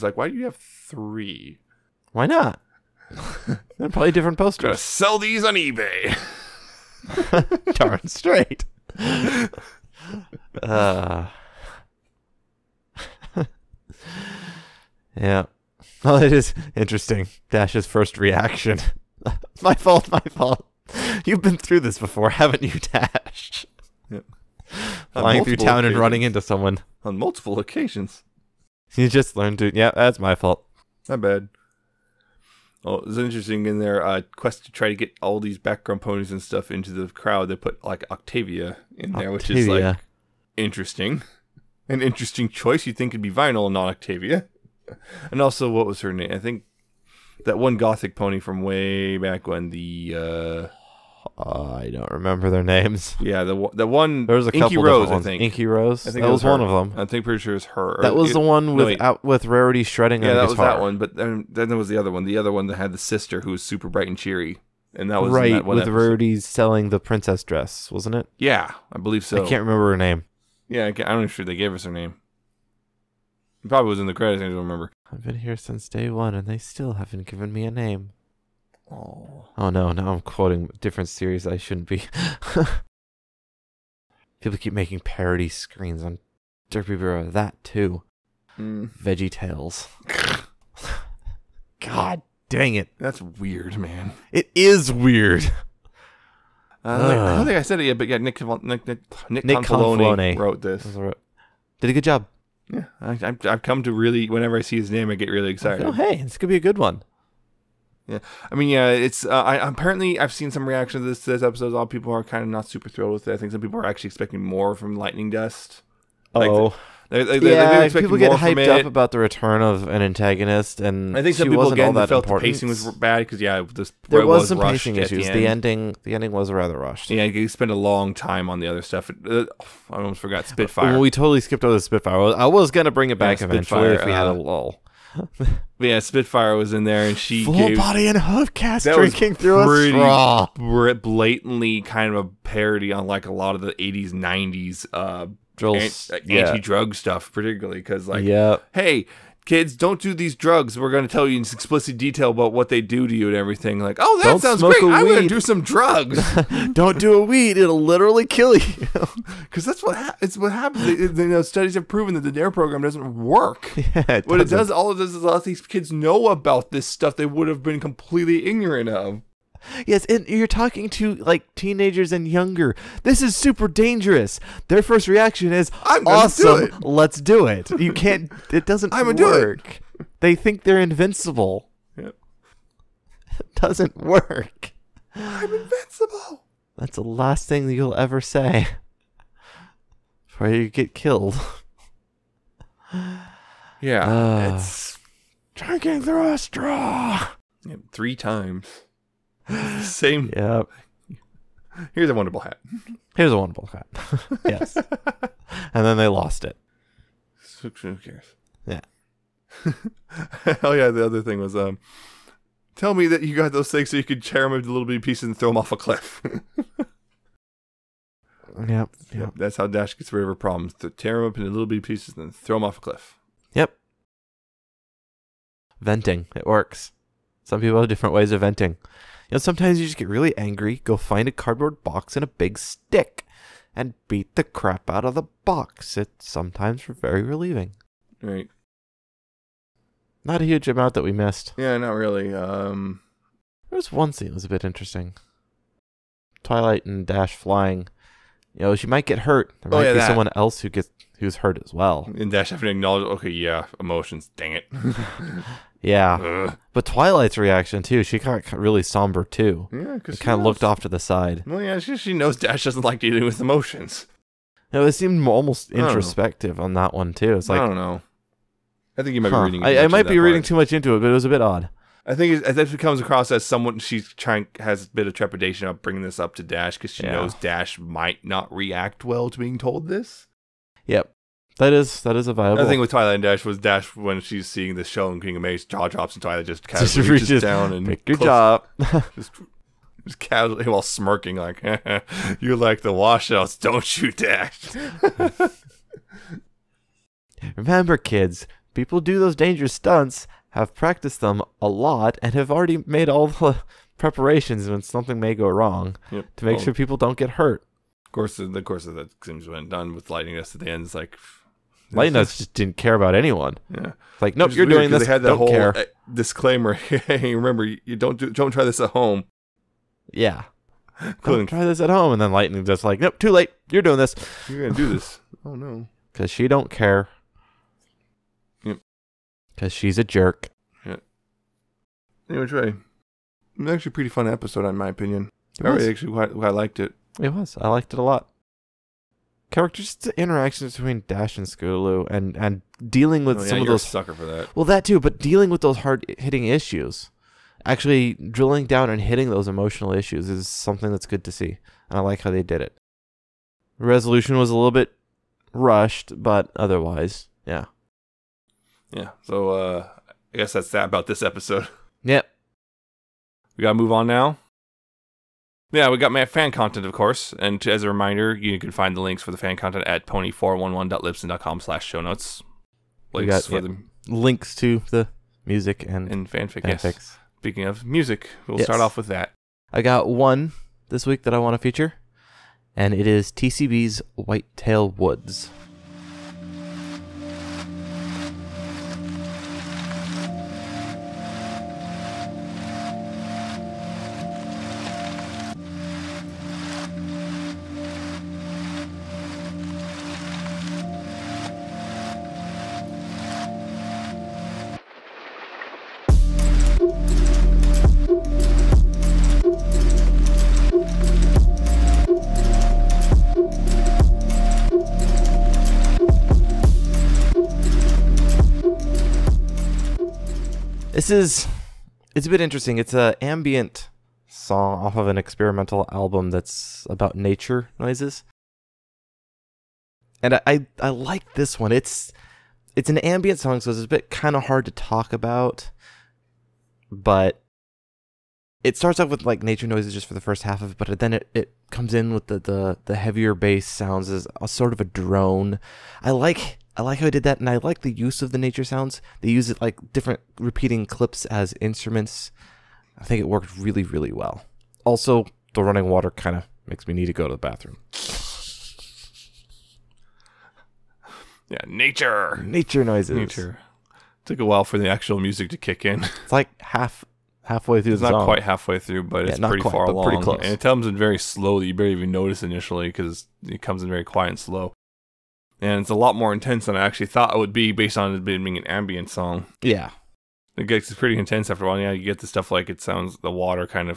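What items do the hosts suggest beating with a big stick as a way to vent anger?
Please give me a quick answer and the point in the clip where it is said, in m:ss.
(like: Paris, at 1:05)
cardboard box, at 3:51.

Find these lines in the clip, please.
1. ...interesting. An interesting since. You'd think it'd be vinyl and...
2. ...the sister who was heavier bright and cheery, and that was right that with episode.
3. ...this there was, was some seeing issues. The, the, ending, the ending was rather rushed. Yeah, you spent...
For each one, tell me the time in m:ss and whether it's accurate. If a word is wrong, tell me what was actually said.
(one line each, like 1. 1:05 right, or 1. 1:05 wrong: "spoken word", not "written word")
1. 0:40 wrong: "choice", not "since"
2. 1:02 wrong: "super", not "heavier"
3. 2:03 wrong: "pacing", not "seeing".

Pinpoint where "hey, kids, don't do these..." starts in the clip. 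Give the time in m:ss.
2:28.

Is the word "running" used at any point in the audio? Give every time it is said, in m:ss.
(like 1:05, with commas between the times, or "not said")
0:25, 7:35.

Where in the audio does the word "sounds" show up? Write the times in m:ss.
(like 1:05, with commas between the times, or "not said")
2:34, 7:23, 7:28, 8:02.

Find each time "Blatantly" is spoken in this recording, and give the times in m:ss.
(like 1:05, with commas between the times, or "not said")
2:20.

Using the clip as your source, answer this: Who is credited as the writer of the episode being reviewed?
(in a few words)
Nick Confalone.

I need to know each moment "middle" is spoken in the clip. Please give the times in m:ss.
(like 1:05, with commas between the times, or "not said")
not said.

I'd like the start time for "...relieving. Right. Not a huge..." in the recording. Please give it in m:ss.
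3:57.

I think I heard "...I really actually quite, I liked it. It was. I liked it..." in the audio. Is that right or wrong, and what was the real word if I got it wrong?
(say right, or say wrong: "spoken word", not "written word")
right.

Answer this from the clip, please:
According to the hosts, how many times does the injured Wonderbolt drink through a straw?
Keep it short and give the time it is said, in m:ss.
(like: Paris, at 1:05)
3, at 3:17.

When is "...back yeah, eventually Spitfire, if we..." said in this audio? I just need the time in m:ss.
2:13.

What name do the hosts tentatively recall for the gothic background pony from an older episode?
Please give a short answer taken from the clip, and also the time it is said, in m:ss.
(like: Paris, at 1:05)
Inky Rose, at 0:55.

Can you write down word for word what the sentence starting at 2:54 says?
Their first reaction is "I'm awesome.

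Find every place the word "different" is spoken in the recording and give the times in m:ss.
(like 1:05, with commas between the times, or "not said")
0:04, 1:20, 3:47, 7:29.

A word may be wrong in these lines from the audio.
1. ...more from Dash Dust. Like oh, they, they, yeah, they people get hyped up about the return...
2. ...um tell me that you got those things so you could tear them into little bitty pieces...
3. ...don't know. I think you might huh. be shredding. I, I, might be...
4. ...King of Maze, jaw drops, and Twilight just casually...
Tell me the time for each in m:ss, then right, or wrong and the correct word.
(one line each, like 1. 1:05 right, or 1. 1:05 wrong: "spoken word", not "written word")
1. 1:54 wrong: "Lightning", not "Dash"
2. 3:31 right
3. 4:27 wrong: "reading", not "shredding"
4. 4:45 right.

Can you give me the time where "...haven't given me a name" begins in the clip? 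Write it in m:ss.
1:16.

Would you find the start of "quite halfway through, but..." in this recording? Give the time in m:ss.
7:48.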